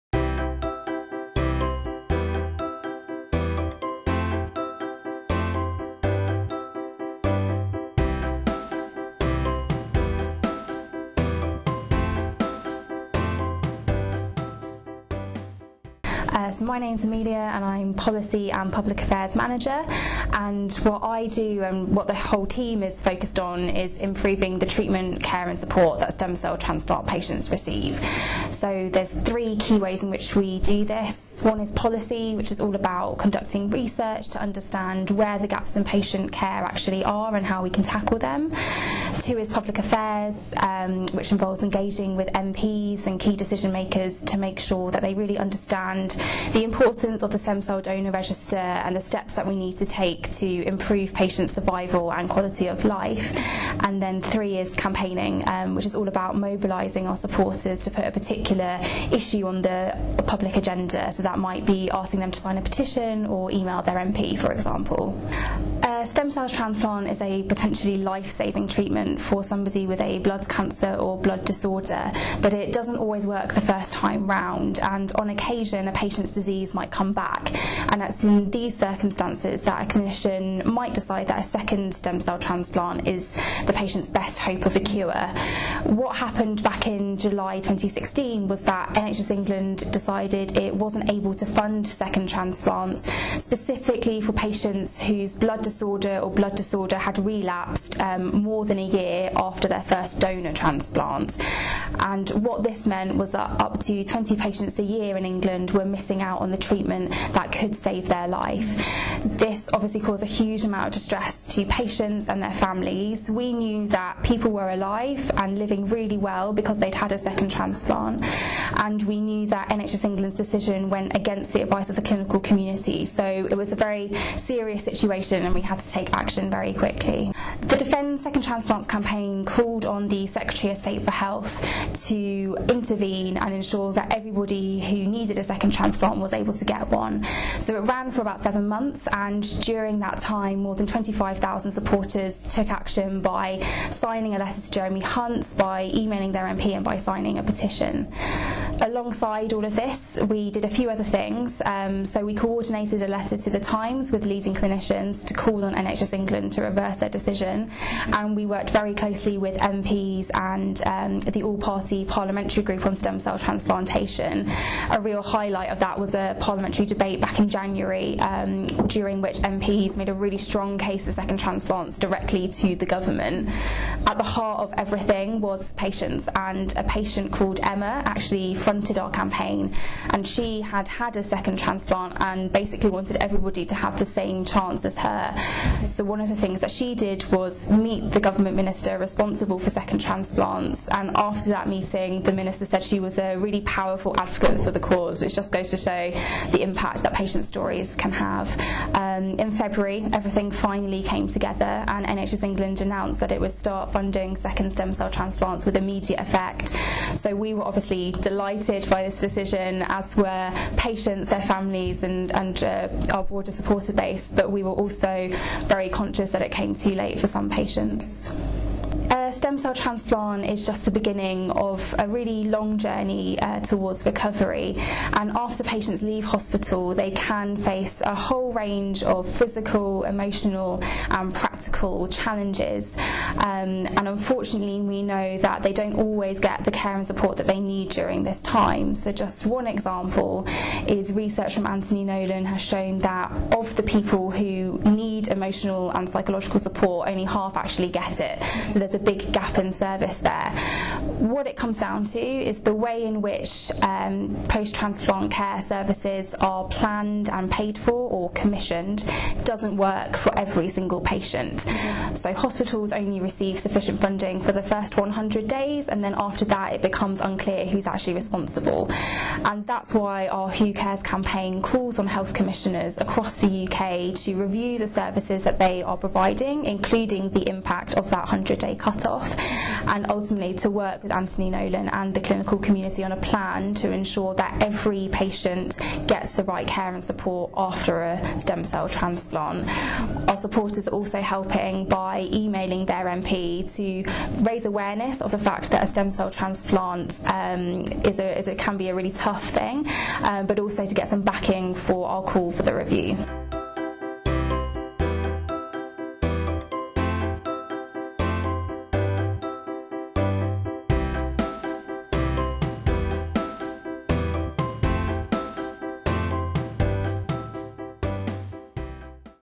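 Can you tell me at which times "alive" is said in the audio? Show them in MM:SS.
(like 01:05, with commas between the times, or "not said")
01:54.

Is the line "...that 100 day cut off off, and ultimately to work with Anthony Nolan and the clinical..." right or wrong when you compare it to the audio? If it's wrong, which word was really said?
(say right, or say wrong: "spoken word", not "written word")
right.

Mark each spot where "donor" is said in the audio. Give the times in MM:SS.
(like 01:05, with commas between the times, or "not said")
00:47, 01:40.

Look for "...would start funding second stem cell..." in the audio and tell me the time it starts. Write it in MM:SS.
03:23.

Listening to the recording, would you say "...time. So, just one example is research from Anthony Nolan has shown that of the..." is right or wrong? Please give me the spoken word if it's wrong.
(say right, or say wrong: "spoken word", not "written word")
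right.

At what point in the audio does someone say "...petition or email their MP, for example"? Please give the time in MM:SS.
01:02.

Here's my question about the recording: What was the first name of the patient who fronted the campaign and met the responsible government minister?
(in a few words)
Emma.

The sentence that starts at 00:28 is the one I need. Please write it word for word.
So there's three key ways in which we do this.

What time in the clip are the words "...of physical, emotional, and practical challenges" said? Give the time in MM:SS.
03:49.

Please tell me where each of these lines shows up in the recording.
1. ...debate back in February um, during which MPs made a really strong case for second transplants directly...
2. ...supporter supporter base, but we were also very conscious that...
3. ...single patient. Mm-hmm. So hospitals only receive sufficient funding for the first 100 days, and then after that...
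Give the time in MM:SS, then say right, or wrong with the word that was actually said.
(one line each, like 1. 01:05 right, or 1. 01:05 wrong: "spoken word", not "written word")
1. 02:46 wrong: "January", not "February"
2. 03:33 wrong: "broader", not "supporter"
3. 04:20 right.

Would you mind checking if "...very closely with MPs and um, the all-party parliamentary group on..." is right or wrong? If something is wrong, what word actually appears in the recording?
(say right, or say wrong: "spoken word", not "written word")
right.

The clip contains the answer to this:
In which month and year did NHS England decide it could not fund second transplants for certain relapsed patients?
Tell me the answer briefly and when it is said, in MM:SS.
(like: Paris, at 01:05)
July 2016, at 01:27.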